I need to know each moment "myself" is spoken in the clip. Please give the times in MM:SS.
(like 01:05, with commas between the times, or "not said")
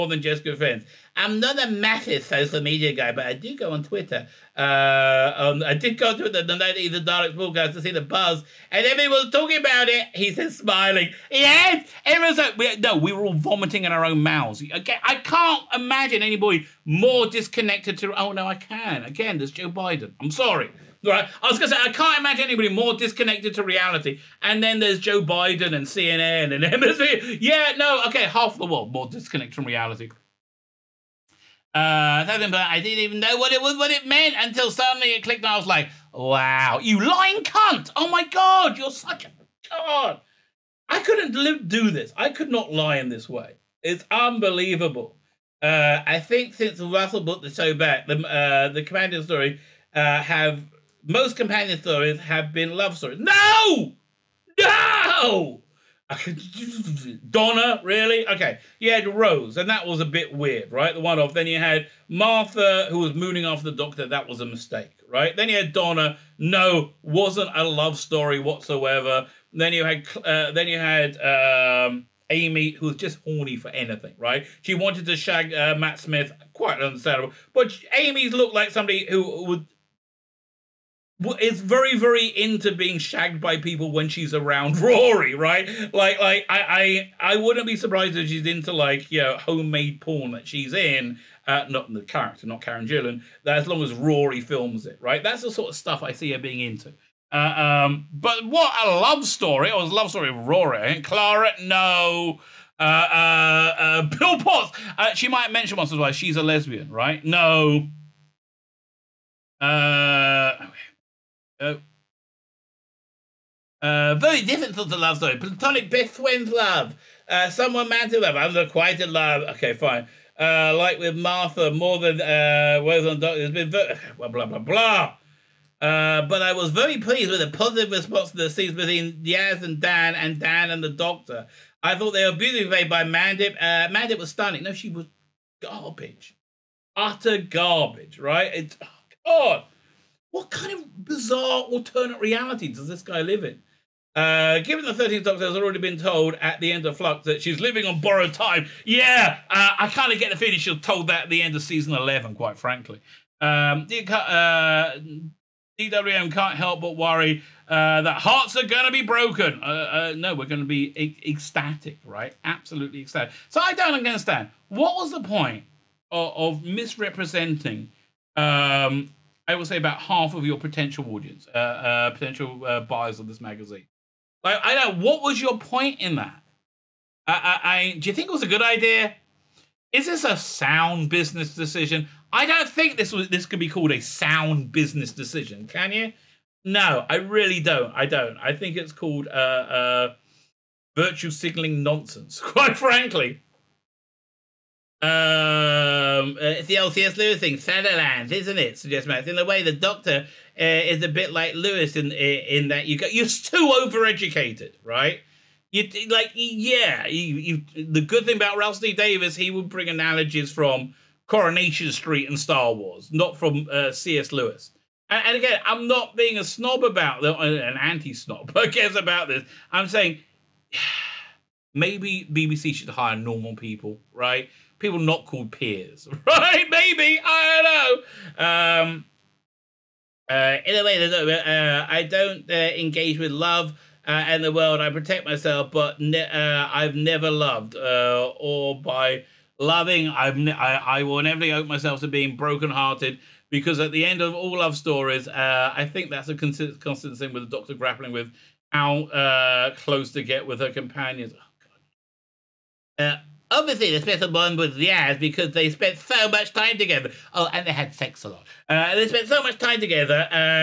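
03:55, 04:01.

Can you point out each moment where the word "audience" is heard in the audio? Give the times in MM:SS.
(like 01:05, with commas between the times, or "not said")
02:51.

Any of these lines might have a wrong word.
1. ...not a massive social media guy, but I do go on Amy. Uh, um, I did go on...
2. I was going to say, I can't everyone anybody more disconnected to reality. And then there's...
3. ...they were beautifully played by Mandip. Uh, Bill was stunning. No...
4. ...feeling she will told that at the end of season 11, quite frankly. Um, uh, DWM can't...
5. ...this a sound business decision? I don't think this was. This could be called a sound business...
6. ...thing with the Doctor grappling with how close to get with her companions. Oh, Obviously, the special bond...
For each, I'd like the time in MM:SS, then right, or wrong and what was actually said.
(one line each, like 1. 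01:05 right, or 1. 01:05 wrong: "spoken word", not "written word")
1. 00:01 wrong: "Twitter", not "Amy"
2. 00:21 wrong: "imagine", not "everyone"
3. 02:12 wrong: "Mandip", not "Bill"
4. 02:30 right
5. 03:00 right
6. 04:07 right.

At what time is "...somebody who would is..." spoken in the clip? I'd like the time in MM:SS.
01:18.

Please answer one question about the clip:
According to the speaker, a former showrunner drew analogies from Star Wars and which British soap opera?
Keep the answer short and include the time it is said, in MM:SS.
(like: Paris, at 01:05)
Coronation Street, at 03:31.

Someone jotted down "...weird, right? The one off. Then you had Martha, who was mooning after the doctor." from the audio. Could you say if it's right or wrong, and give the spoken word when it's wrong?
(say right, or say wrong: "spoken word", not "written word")
right.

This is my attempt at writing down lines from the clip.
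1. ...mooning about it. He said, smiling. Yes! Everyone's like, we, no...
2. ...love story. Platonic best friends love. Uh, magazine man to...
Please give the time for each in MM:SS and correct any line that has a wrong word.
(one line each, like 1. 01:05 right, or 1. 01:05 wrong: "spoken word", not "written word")
1. 00:09 wrong: "talking", not "mooning"
2. 01:54 wrong: "someone", not "magazine".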